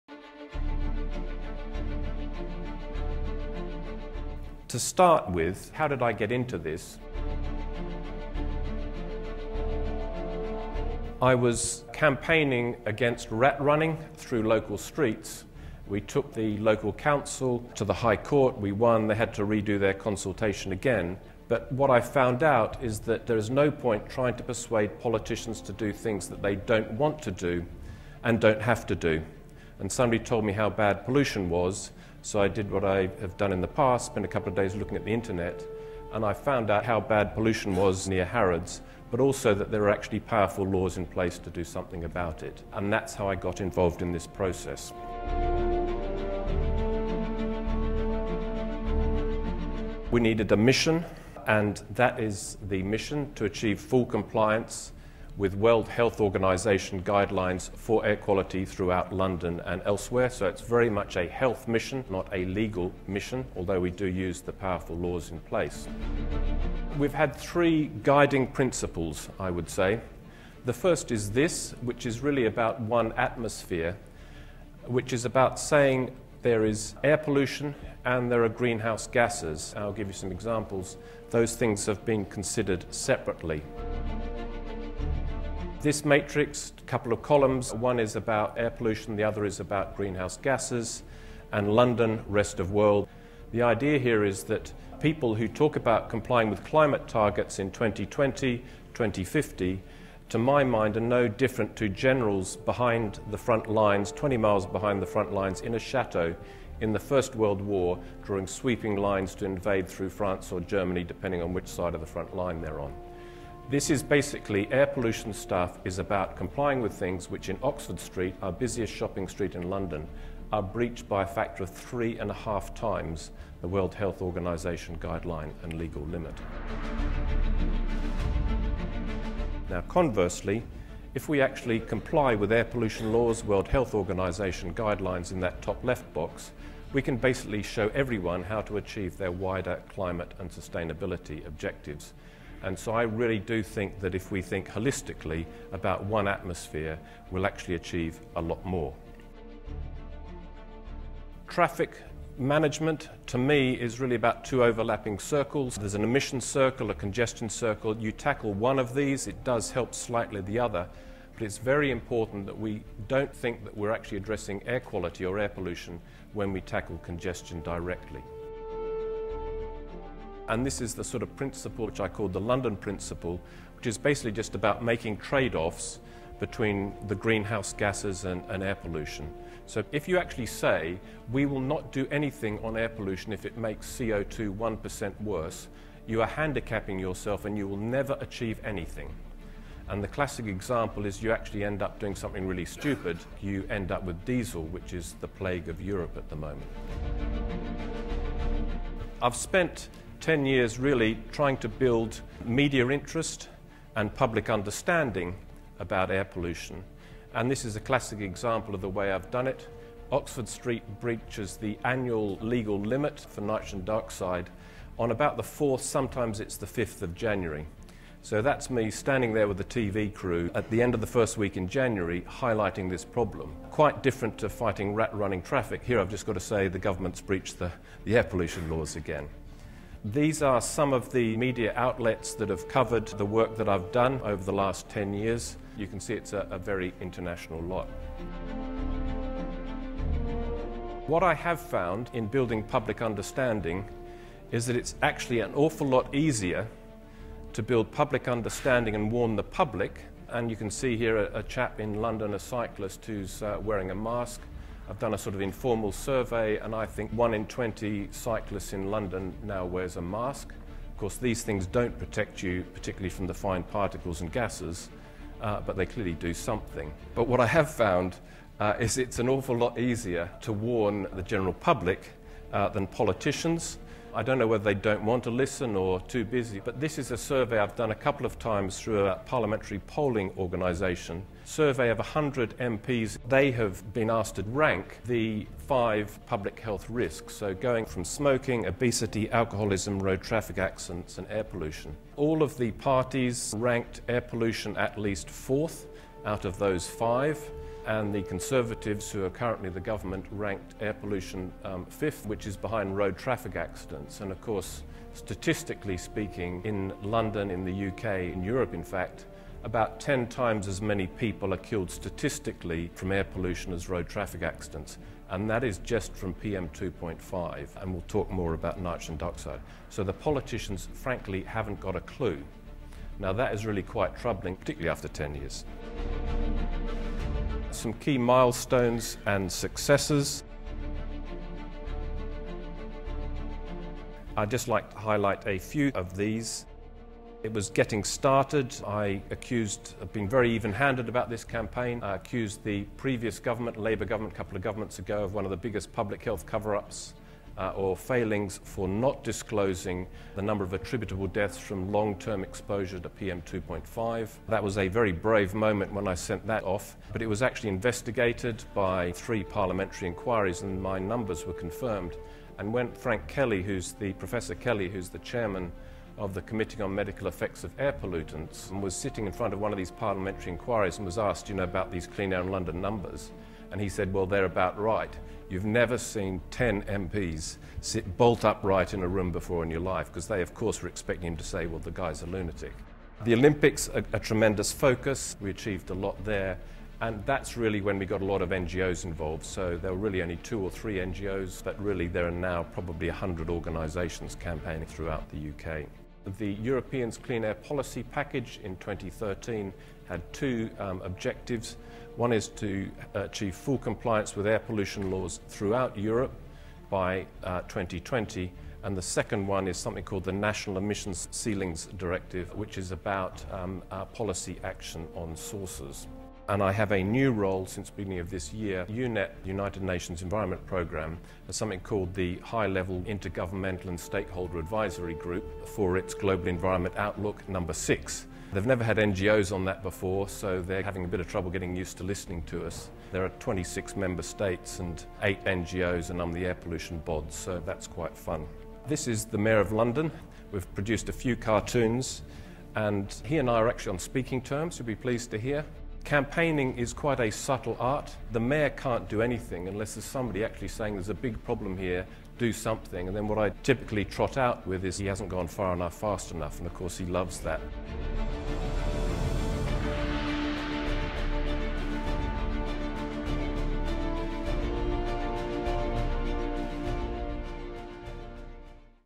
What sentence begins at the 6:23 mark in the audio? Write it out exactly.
The Olympics, a, a, tremendous focus.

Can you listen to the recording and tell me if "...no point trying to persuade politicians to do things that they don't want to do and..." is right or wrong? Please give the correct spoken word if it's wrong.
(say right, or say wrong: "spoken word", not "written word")
right.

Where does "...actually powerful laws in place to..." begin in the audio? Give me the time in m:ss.
0:39.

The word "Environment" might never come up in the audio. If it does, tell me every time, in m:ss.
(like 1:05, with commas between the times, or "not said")
7:00, 7:06.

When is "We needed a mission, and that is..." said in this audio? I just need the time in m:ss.
0:50.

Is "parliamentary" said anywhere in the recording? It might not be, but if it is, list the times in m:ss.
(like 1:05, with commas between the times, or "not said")
4:39, 5:59, 6:09.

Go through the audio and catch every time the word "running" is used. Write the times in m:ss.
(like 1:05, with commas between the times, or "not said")
0:13, 3:45.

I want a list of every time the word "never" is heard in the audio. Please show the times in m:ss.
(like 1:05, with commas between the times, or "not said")
3:07, 6:15, 7:08.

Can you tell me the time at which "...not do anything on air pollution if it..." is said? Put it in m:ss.
3:01.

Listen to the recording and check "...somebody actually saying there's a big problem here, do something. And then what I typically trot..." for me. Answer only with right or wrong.
right.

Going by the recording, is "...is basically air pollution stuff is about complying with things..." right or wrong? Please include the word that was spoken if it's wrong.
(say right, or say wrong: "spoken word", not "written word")
right.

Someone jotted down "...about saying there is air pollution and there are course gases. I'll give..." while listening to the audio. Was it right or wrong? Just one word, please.
wrong.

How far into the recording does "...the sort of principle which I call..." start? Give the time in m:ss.
2:50.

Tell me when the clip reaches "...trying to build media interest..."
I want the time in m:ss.
3:21.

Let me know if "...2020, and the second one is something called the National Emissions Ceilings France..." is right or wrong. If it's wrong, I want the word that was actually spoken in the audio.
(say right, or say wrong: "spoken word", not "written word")
wrong: "Directive", not "France".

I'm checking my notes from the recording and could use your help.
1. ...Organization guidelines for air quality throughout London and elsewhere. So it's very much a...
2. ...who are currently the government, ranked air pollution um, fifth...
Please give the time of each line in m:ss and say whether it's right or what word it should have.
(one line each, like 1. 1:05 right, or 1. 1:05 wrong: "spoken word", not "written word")
1. 0:56 right
2. 4:59 right.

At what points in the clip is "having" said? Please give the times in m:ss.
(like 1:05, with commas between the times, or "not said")
7:10.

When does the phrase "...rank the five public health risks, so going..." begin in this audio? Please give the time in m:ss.
4:44.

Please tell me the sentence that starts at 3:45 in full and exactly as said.
Here I've just got to say the government's breached the, the air pollution laws again.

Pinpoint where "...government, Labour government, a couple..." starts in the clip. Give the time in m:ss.
5:43.